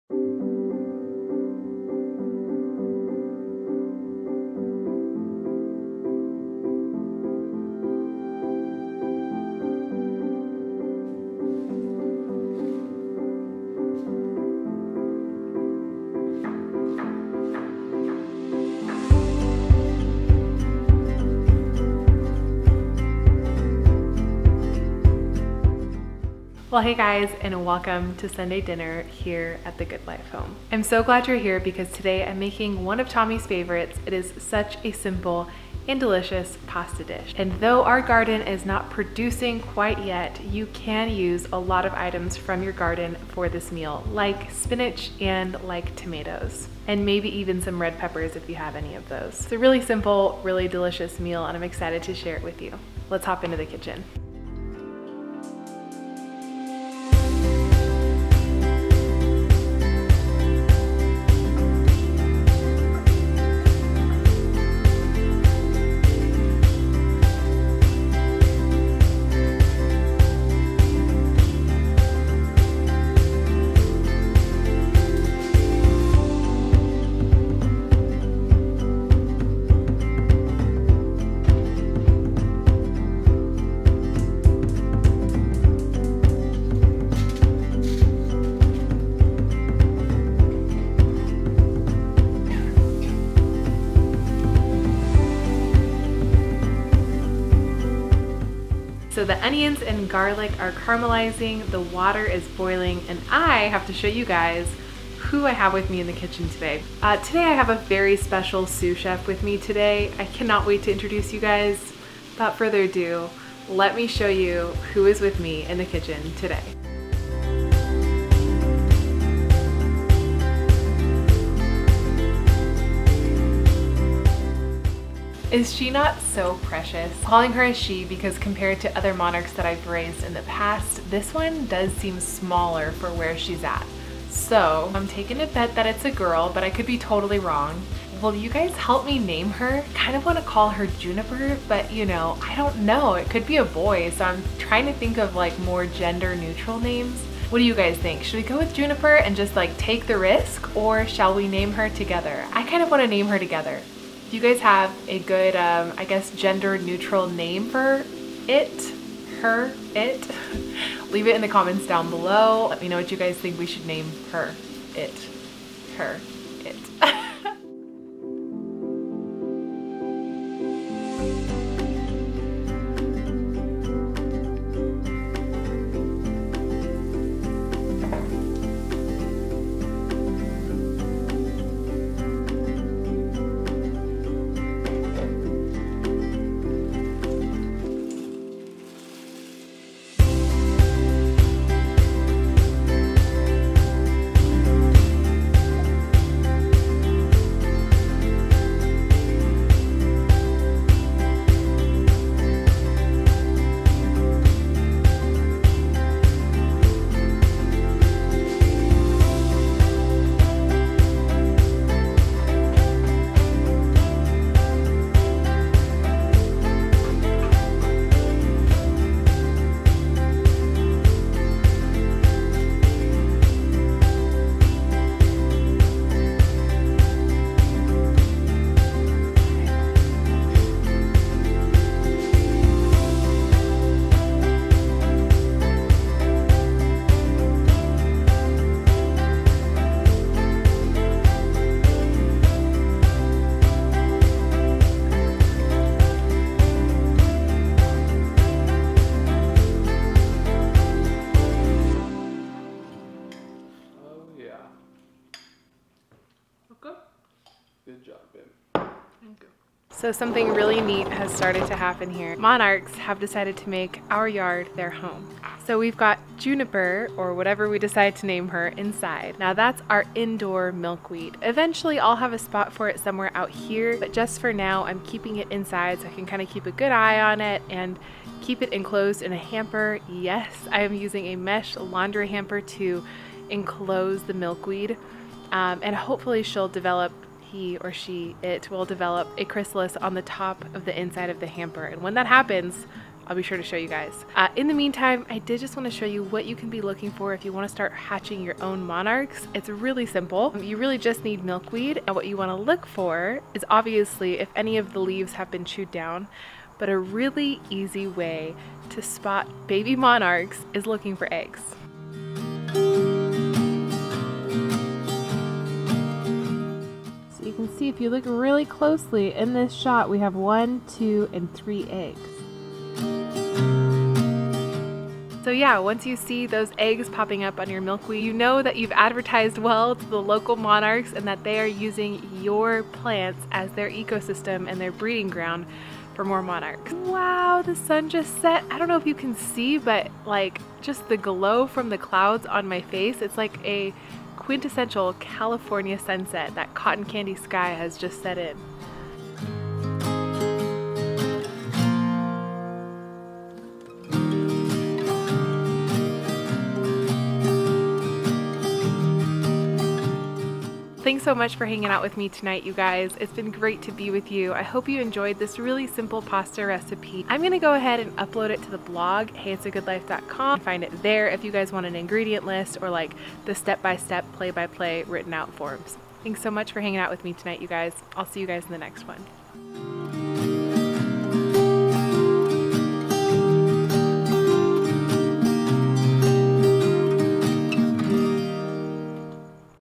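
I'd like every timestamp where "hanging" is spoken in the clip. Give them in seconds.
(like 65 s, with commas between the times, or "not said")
361 s, 376 s.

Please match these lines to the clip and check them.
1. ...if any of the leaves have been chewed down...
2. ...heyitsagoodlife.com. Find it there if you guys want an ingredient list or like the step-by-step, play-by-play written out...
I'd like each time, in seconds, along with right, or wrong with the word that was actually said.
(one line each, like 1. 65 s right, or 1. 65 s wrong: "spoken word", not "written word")
1. 304 s right
2. 369 s right.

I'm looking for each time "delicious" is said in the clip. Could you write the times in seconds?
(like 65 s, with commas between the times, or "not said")
35 s, 50 s.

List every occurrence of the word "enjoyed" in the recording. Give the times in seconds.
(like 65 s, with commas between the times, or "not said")
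364 s.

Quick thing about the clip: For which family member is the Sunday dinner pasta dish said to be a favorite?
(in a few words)
Tommy.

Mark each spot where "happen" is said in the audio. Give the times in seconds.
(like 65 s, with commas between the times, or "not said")
261 s, 292 s.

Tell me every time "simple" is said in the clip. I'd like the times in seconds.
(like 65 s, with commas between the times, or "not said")
34 s, 49 s, 300 s, 365 s.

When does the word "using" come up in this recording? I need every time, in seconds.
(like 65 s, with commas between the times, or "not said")
280 s, 331 s.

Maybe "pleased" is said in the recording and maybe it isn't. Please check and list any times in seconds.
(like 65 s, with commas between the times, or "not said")
not said.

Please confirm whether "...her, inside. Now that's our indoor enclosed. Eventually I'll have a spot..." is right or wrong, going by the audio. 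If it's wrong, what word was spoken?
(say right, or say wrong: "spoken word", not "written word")
wrong: "milkweed", not "enclosed".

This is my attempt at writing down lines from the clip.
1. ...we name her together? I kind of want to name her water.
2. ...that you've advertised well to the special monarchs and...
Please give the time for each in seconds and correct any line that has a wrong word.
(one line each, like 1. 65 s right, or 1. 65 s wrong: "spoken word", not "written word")
1. 151 s wrong: "together", not "water"
2. 328 s wrong: "local", not "special".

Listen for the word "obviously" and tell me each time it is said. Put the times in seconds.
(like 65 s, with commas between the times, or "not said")
303 s.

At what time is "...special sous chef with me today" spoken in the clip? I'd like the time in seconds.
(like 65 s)
108 s.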